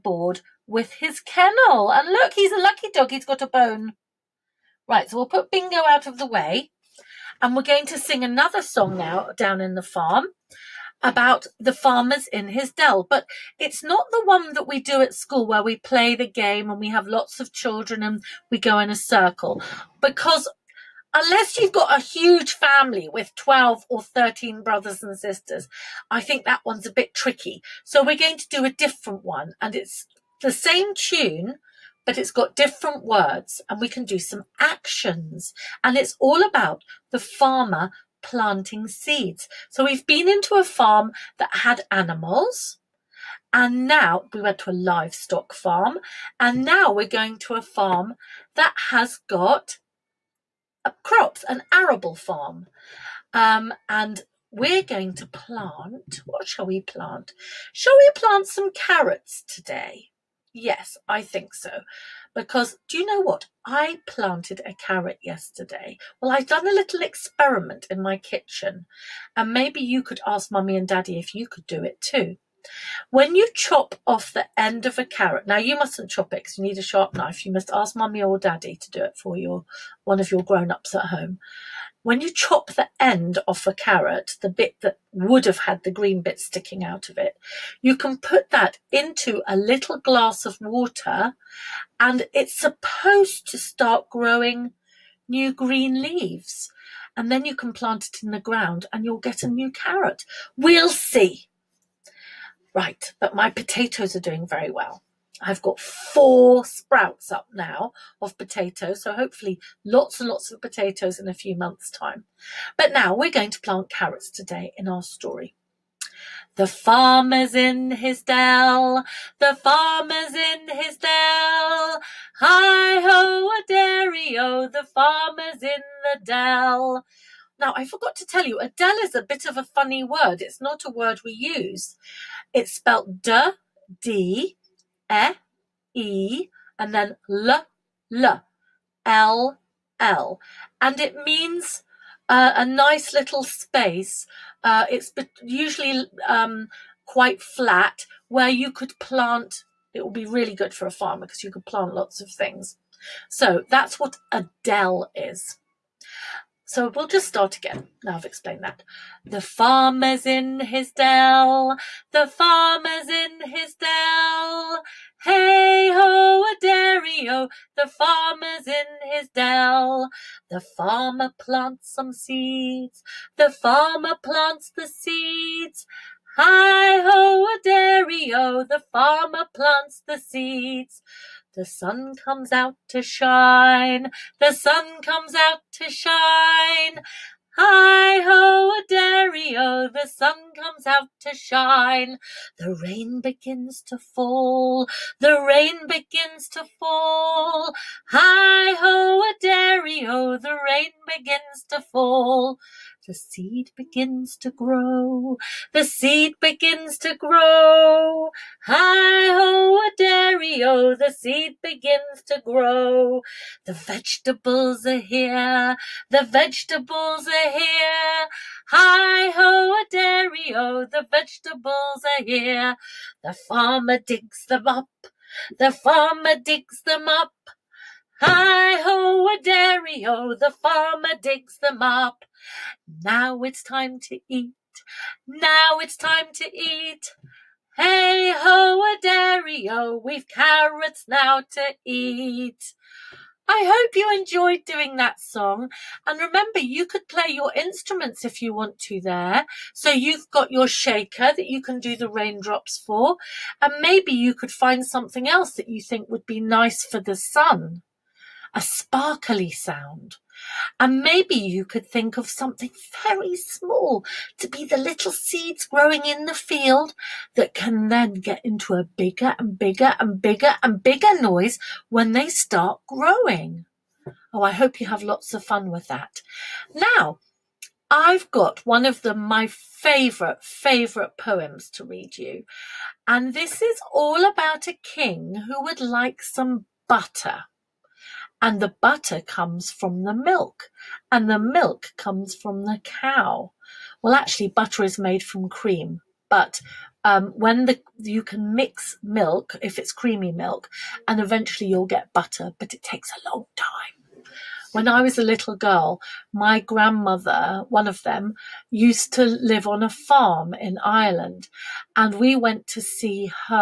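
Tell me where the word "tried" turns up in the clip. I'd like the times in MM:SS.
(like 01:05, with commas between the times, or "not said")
not said.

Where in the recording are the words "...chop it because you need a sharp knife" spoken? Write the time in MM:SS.
01:16.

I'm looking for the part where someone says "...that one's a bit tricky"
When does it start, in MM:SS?
00:26.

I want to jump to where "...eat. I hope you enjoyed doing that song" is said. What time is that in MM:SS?
04:01.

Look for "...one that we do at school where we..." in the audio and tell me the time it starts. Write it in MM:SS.
00:14.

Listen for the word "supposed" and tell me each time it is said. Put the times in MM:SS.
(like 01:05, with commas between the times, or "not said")
01:32.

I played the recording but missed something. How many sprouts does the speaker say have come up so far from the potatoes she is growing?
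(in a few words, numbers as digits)
4.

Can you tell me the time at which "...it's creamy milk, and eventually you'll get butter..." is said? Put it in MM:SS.
04:59.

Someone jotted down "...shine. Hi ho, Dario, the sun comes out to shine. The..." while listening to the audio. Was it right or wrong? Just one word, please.
right.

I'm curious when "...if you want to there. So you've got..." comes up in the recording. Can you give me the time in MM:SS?
04:08.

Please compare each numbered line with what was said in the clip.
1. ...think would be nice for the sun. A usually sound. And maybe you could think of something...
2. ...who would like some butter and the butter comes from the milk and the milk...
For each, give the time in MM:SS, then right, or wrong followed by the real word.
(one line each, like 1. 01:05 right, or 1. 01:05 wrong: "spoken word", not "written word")
1. 04:15 wrong: "sparkly", not "usually"
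2. 04:45 right.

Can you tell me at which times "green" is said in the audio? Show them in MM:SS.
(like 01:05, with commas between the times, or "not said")
01:25, 01:35.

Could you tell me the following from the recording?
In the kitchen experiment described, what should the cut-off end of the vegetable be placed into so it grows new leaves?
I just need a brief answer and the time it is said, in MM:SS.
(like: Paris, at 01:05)
a little glass of water, at 01:29.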